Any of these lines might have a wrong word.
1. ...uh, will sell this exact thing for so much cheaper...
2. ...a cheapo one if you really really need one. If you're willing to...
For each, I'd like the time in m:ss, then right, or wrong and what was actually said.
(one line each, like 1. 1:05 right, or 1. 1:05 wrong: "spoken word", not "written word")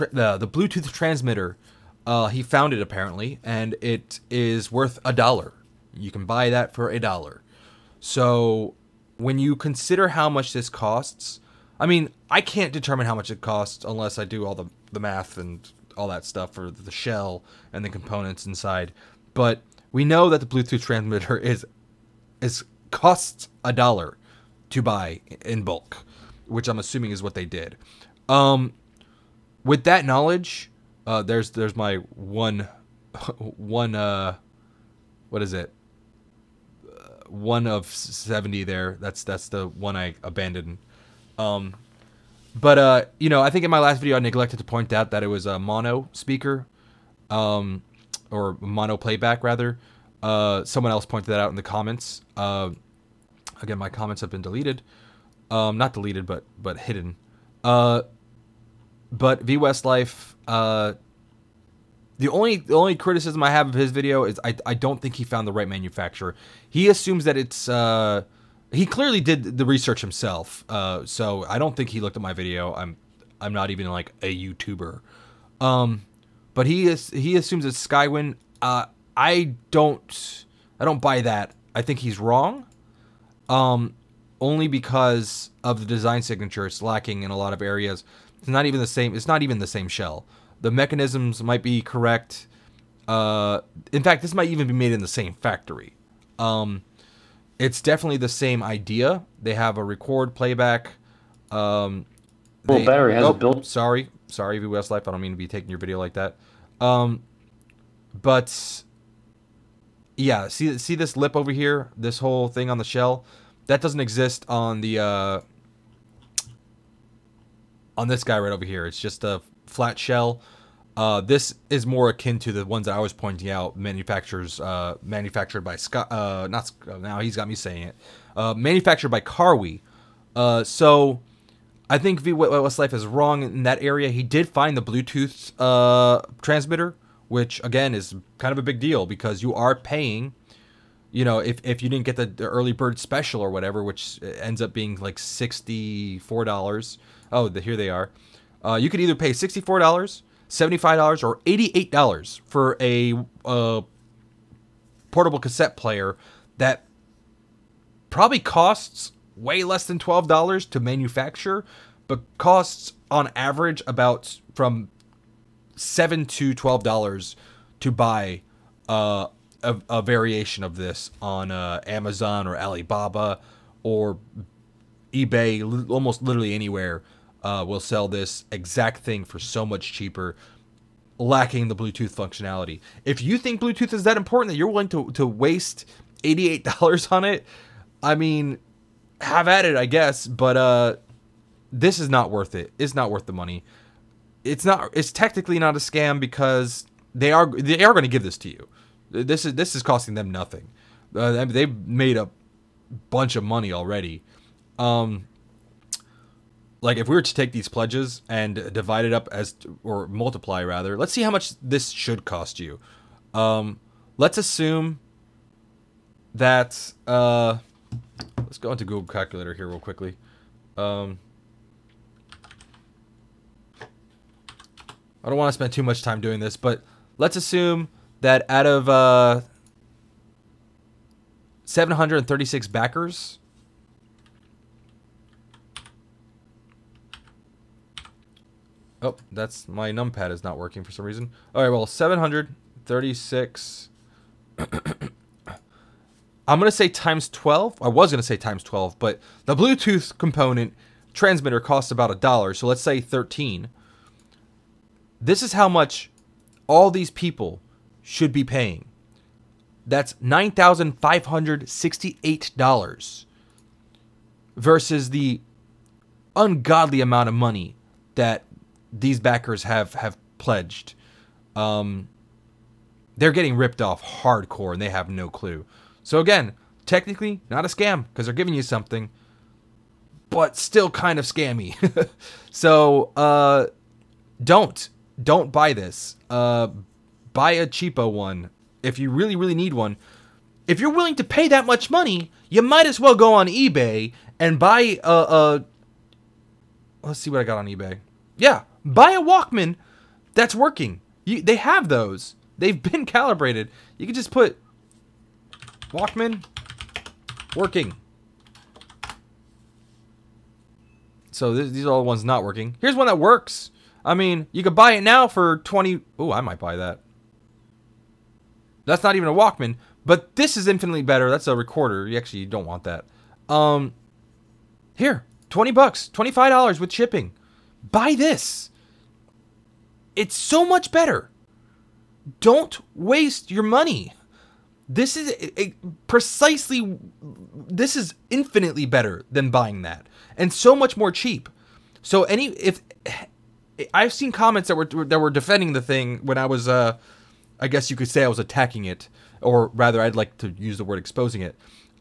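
1. 2:57 right
2. 4:47 right.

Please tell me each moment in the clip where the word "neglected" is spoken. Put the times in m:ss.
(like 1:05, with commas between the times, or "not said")
0:44.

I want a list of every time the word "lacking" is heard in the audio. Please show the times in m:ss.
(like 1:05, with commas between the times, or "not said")
1:26, 3:01.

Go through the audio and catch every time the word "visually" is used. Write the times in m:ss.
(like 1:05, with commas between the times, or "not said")
not said.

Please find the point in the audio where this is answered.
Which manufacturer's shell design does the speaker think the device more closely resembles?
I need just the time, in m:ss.
2:09.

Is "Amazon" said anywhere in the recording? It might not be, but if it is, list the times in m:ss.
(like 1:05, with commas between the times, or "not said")
2:51.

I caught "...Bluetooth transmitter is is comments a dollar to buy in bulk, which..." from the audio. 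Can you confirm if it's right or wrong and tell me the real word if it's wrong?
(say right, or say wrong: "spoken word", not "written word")
wrong: "costs", not "comments".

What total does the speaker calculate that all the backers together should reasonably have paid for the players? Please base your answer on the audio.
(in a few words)
$9,568.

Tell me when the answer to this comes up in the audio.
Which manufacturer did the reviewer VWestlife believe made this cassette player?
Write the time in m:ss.
1:17.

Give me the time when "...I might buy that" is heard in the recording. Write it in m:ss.
5:16.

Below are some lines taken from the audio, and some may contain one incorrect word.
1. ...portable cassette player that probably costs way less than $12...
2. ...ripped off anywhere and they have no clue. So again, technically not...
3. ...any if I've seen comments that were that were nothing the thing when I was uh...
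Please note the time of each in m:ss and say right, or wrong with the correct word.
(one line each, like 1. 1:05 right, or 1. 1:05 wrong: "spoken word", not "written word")
1. 2:35 right
2. 4:33 wrong: "hardcore", not "anywhere"
3. 5:42 wrong: "defending", not "nothing".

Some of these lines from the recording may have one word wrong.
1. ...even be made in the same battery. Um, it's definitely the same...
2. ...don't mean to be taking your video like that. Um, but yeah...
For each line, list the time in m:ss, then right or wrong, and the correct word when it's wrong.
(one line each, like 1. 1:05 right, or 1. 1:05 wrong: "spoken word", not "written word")
1. 1:34 wrong: "factory", not "battery"
2. 1:45 right.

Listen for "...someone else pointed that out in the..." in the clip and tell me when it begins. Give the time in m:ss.
0:50.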